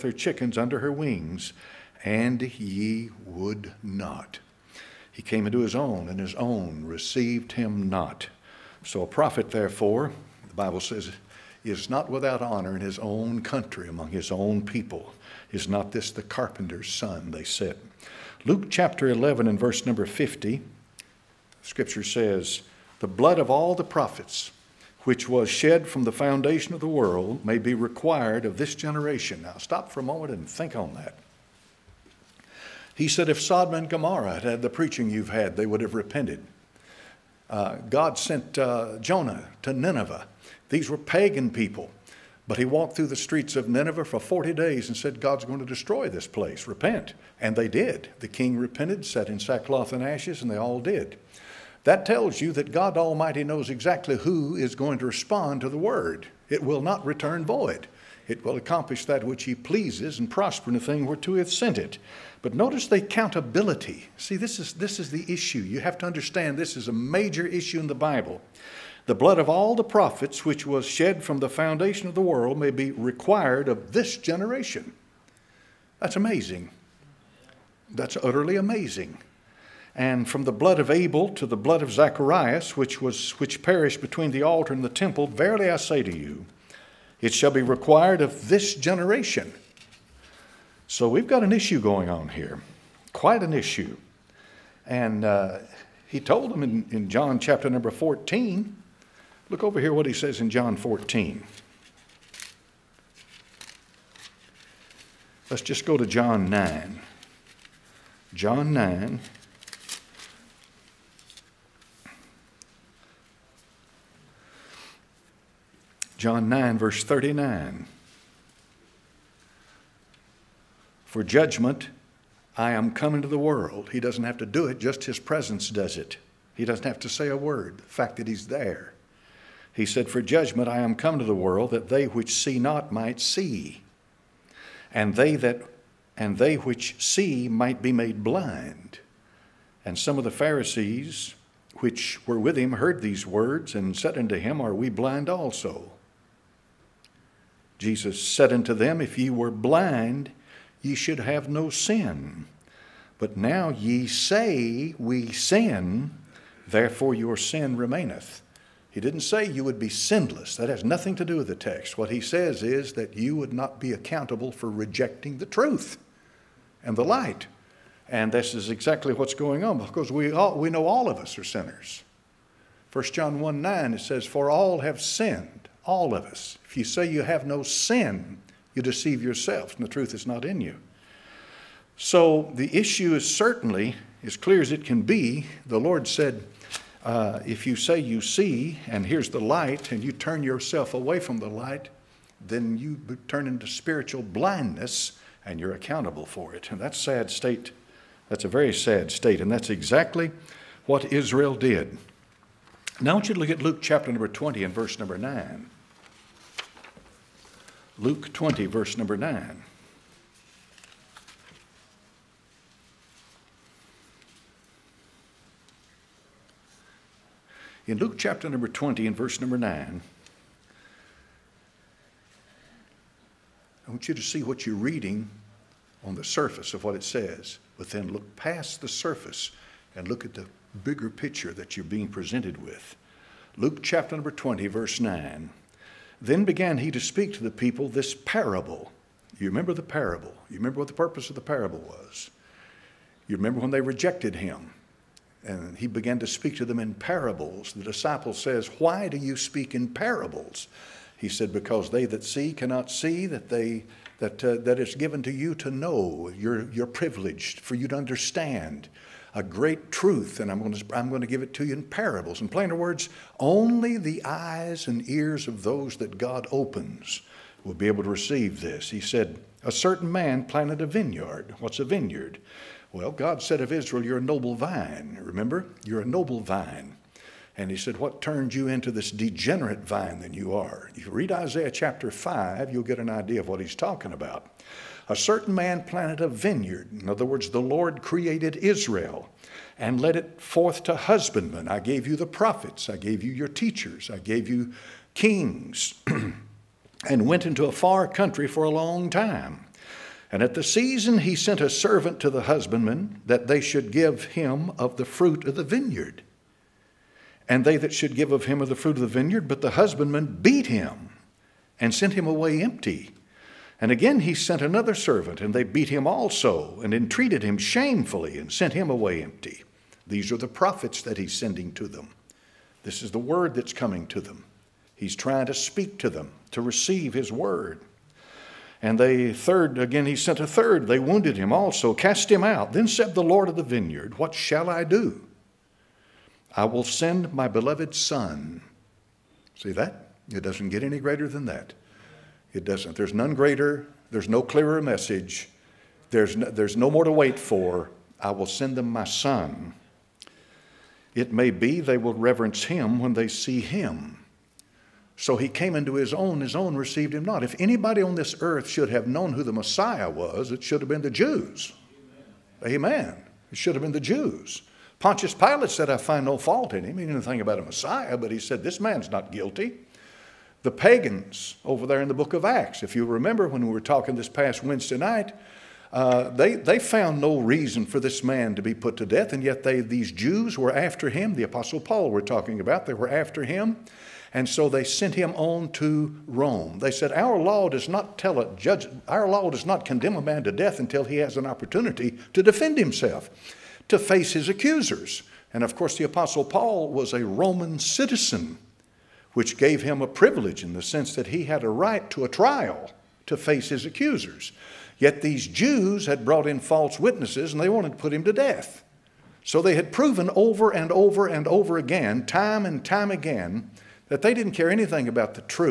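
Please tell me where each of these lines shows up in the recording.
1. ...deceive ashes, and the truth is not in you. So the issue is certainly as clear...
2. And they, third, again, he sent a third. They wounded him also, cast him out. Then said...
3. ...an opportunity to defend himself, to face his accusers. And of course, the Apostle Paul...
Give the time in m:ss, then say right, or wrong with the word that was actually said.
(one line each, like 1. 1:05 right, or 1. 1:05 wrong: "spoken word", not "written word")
1. 2:58 wrong: "yourselves", not "ashes"
2. 5:28 right
3. 6:31 right.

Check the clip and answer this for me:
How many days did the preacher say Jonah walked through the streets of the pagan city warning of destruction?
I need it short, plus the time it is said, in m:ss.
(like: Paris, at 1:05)
40, at 0:44.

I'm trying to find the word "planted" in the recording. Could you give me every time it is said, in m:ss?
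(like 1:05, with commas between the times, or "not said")
4:30, 4:45.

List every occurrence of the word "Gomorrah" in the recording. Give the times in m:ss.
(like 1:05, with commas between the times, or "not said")
0:33.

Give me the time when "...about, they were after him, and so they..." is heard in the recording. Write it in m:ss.
6:22.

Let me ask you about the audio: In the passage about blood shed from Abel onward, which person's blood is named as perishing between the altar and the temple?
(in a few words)
Zacharias.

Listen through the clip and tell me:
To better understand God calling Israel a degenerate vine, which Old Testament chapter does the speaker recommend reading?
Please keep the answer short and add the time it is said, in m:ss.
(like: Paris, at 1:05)
Isaiah chapter 5, at 4:41.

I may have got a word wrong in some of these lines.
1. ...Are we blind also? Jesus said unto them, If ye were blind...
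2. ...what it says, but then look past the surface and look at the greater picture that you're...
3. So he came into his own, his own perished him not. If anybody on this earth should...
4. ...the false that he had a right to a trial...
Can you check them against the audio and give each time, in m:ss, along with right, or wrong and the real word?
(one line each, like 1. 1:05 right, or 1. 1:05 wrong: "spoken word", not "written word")
1. 2:24 right
2. 3:46 wrong: "bigger", not "greater"
3. 5:55 wrong: "received", not "perished"
4. 6:40 wrong: "sense", not "false".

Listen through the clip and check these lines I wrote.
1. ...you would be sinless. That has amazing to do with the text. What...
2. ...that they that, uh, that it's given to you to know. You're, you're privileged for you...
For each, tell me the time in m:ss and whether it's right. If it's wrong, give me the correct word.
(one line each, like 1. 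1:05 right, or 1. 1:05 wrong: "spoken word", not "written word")
1. 2:39 wrong: "nothing", not "amazing"
2. 4:13 right.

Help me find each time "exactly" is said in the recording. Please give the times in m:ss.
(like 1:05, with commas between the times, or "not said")
0:53, 2:48, 3:19.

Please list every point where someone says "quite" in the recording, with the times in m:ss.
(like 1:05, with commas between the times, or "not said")
1:33.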